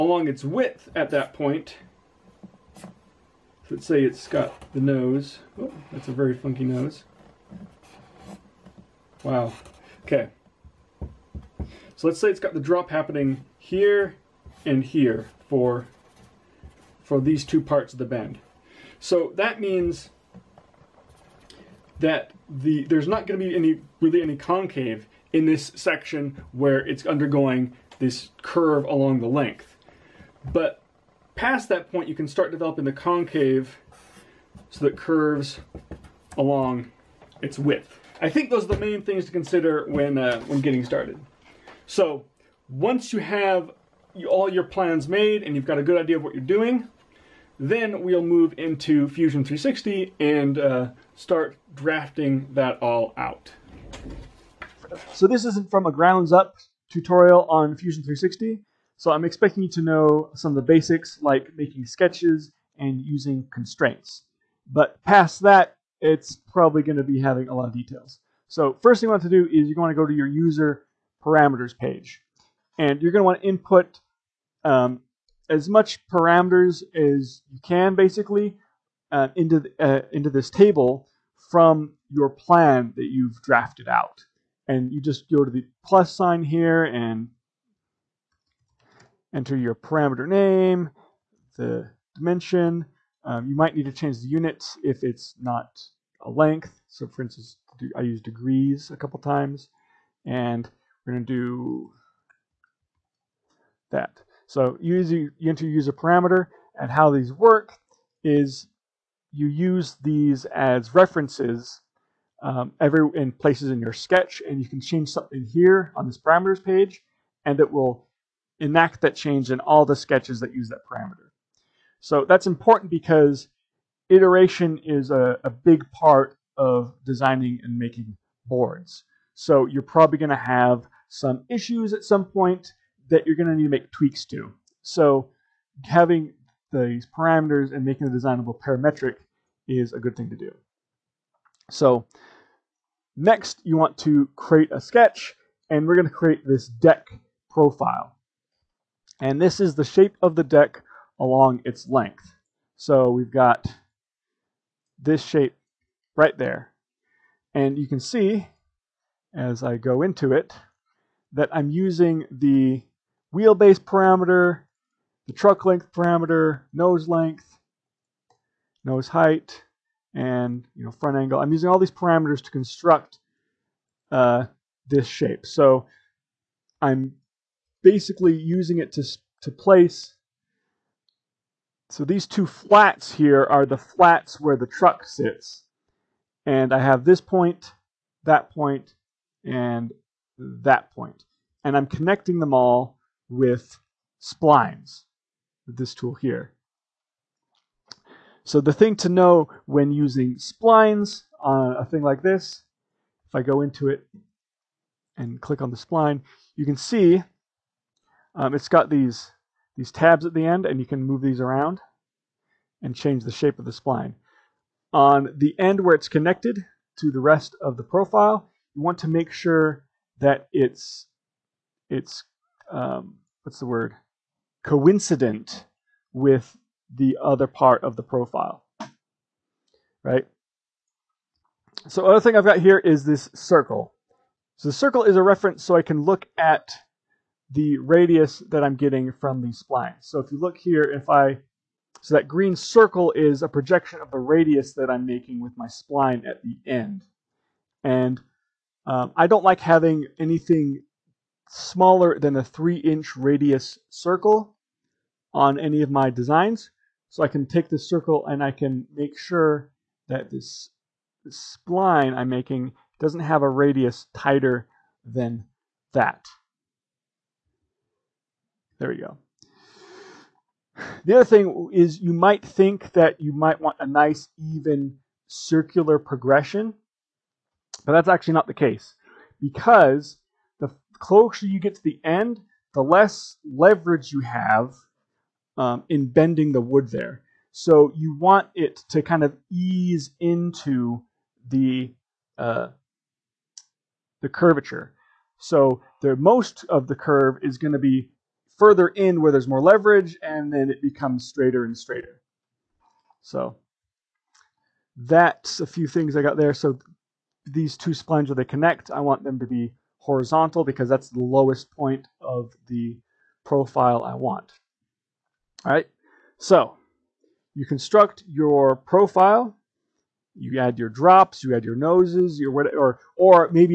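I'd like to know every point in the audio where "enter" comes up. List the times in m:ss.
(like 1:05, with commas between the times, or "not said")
1:29, 1:44.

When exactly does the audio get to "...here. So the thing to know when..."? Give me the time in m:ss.
3:16.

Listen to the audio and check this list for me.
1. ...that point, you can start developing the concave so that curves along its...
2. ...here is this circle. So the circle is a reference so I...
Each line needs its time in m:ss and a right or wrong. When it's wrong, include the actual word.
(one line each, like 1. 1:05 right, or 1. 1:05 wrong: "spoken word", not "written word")
1. 0:31 right
2. 3:52 right.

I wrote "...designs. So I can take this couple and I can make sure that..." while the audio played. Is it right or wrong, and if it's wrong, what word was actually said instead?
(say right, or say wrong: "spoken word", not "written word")
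wrong: "circle", not "couple".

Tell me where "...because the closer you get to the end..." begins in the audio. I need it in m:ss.
4:39.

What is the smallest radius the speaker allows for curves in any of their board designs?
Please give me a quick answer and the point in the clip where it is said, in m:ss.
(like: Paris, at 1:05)
3 inches, at 4:12.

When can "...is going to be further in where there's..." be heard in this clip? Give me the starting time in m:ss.
4:57.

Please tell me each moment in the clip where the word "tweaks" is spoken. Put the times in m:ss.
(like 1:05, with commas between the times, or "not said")
2:13.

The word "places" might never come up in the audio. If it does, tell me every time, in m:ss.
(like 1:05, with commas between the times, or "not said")
1:53, 2:59.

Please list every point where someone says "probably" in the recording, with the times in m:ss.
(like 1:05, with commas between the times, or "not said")
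1:06, 2:09.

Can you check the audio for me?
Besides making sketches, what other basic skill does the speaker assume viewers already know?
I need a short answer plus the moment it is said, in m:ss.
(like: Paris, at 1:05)
Using constraints, at 1:03.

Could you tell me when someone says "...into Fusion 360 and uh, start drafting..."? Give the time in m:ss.
0:48.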